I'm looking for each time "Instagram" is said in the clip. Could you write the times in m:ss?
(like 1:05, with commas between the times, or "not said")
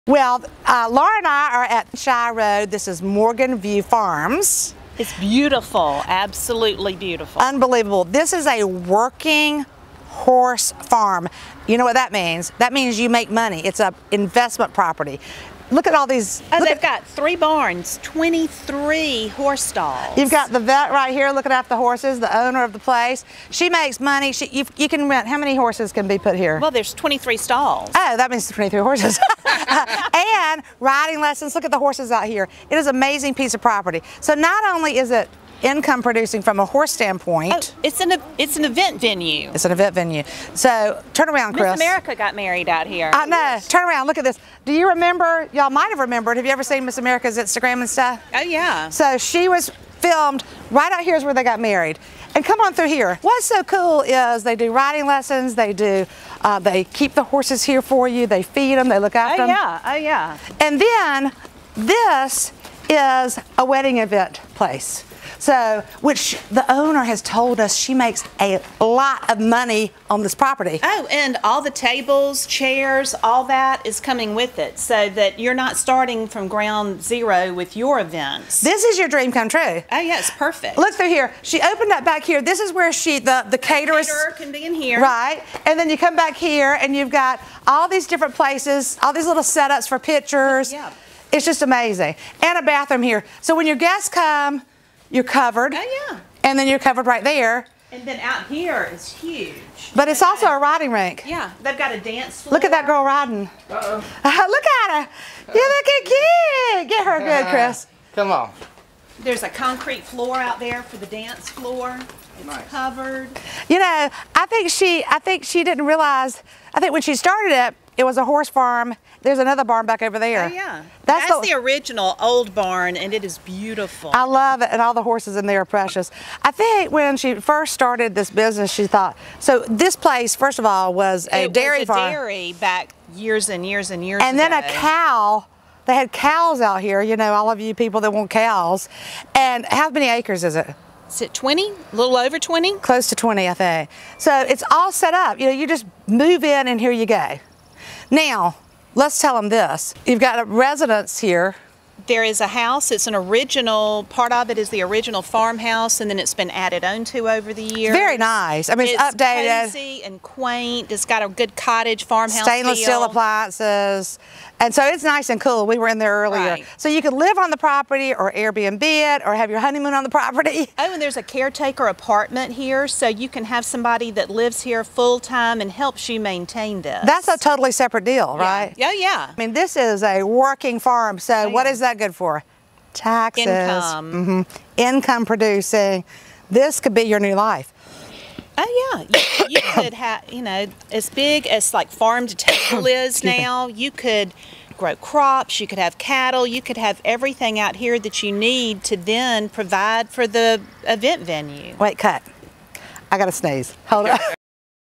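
0:47.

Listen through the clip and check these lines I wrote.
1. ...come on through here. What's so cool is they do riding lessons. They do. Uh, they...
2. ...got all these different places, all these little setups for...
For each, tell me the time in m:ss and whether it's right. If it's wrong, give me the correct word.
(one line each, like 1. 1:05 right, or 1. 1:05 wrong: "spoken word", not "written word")
1. 0:52 right
2. 1:27 right.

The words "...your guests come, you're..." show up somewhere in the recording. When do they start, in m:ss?
1:33.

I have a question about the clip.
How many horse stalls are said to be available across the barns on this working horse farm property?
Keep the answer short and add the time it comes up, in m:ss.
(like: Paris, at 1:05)
23, at 0:18.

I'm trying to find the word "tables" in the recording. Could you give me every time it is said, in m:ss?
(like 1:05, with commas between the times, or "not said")
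1:11, 3:12.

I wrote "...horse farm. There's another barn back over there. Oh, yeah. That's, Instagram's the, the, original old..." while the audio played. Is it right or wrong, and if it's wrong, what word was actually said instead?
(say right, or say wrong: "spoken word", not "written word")
wrong: "That", not "Instagram".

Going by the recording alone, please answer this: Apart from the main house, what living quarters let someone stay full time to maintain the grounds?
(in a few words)
Caretaker apartment.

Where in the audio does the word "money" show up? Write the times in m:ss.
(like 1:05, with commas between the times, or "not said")
0:13, 0:24, 1:09.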